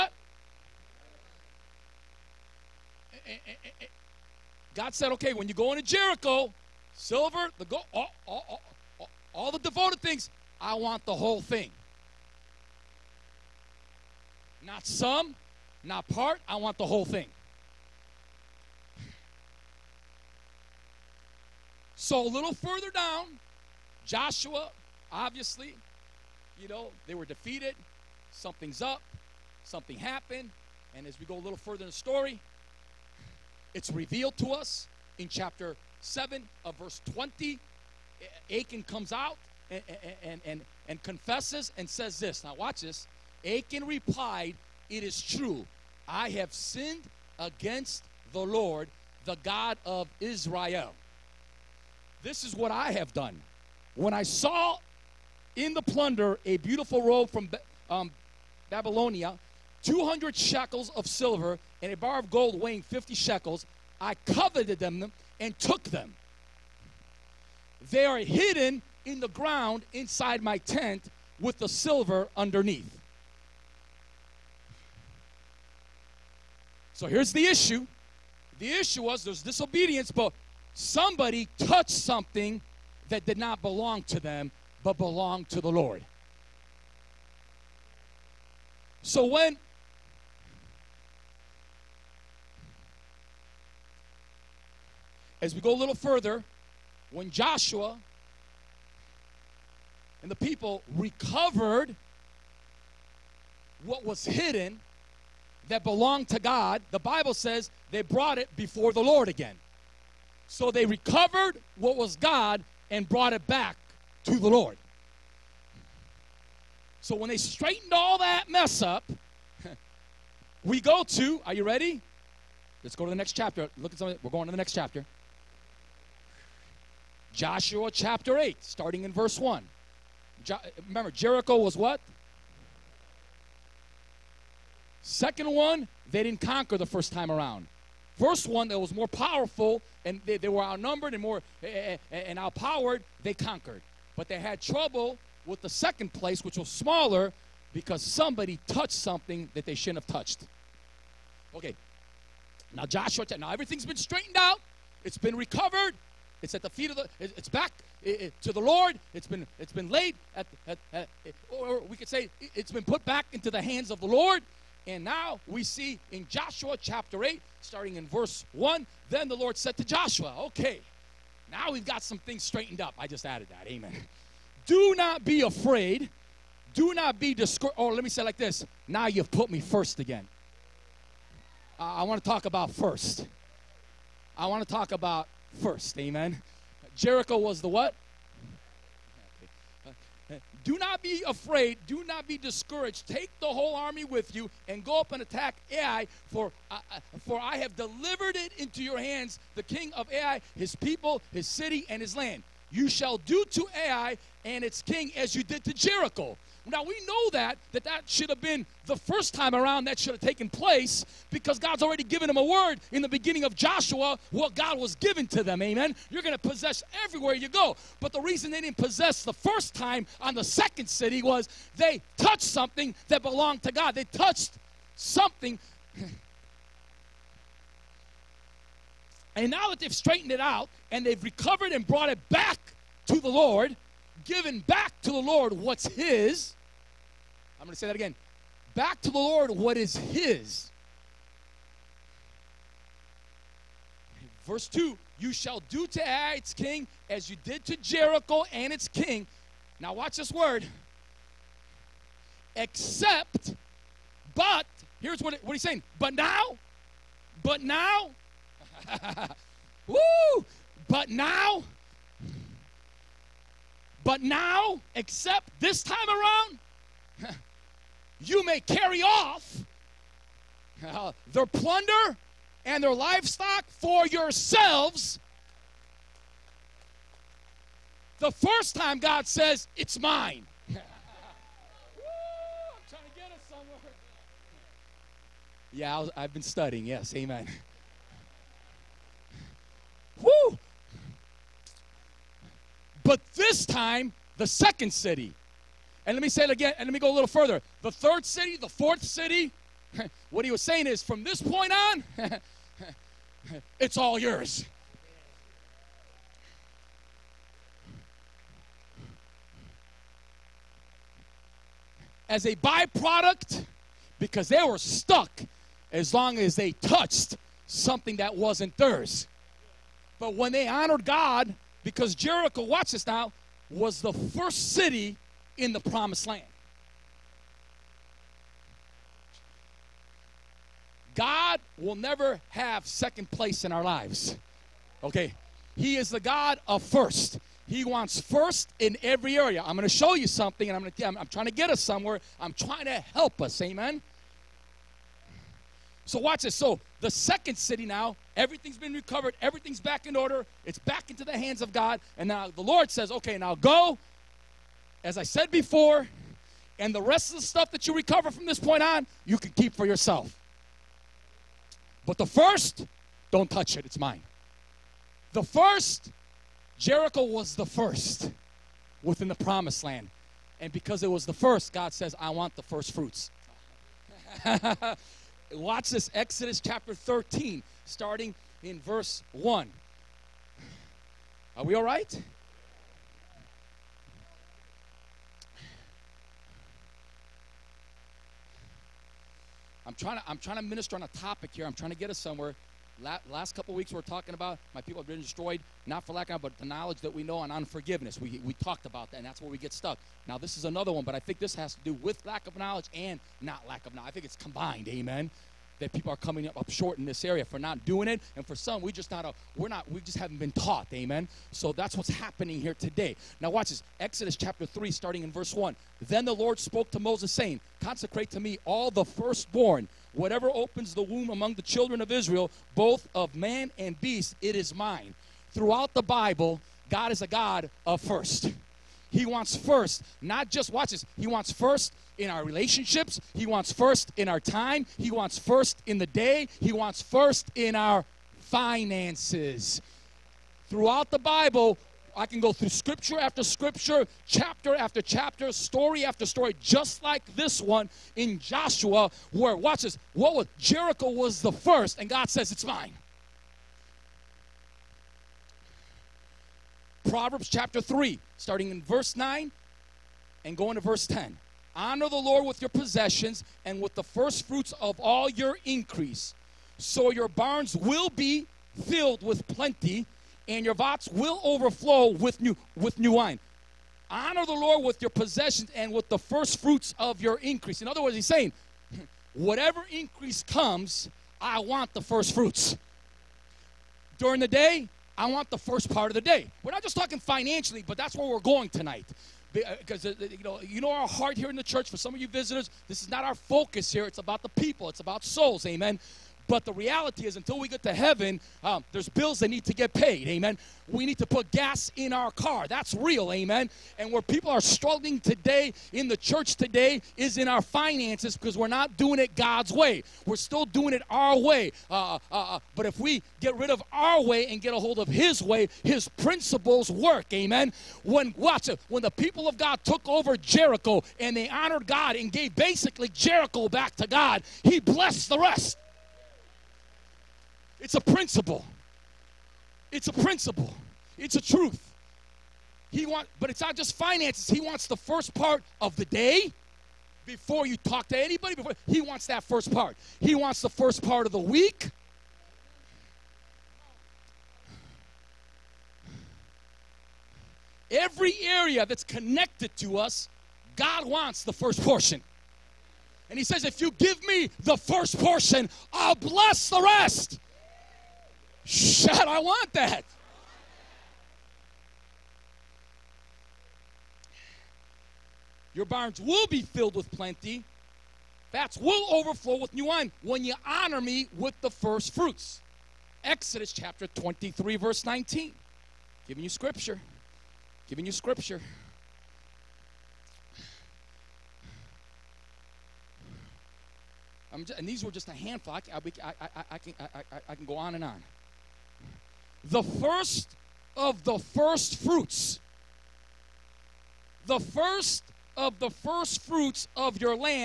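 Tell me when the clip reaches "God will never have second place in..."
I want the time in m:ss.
5:31.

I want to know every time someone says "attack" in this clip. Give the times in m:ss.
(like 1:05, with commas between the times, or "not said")
3:15.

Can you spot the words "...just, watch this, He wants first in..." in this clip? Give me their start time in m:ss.
7:10.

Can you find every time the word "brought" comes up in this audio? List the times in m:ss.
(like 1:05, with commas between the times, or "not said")
1:48, 1:53, 3:51.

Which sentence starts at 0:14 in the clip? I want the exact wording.
Not some, not part, I want the whole thing.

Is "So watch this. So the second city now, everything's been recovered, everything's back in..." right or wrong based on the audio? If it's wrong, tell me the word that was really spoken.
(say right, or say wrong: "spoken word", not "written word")
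right.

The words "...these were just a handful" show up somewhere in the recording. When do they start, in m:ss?
9:44.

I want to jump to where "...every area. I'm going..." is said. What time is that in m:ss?
5:39.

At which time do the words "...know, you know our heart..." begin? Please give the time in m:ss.
8:10.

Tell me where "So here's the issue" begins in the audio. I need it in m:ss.
1:16.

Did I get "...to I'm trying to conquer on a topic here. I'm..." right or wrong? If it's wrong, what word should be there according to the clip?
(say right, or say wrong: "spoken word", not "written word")
wrong: "minister", not "conquer".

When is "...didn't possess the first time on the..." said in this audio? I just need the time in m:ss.
3:38.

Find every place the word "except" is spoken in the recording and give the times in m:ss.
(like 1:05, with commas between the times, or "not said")
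4:12, 4:24.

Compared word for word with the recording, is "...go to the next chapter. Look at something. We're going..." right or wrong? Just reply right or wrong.
right.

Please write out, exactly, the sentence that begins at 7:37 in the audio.
Proverbs chapter 3, starting in verse 9 and going to verse 10.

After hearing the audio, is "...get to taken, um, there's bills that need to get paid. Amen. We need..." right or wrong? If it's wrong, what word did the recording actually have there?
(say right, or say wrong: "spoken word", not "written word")
wrong: "heaven", not "taken".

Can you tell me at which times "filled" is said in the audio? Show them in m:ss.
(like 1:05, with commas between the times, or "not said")
7:48, 9:26.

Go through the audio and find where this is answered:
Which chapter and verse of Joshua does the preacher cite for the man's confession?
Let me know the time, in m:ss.
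0:35.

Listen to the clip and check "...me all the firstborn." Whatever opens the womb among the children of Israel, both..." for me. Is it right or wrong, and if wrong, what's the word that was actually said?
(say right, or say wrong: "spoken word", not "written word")
right.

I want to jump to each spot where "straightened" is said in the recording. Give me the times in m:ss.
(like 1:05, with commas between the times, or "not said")
1:57, 2:33, 2:52, 3:49.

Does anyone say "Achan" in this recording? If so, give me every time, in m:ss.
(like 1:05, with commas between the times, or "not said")
0:38, 0:43.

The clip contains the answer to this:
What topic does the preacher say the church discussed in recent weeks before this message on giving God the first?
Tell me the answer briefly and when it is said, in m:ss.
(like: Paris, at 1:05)
Unforgiveness, at 6:37.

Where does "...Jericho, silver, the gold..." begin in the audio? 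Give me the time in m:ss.
0:05.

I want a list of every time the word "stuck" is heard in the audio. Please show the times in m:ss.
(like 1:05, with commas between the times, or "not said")
5:14, 6:39.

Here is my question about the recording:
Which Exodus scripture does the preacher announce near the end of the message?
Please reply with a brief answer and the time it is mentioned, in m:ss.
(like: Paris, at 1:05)
Exodus 23:19, at 9:33.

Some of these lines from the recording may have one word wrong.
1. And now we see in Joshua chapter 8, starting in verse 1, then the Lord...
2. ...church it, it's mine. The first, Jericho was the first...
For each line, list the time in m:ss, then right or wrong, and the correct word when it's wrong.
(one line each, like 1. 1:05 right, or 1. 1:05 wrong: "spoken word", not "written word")
1. 2:44 right
2. 6:03 wrong: "touch", not "church".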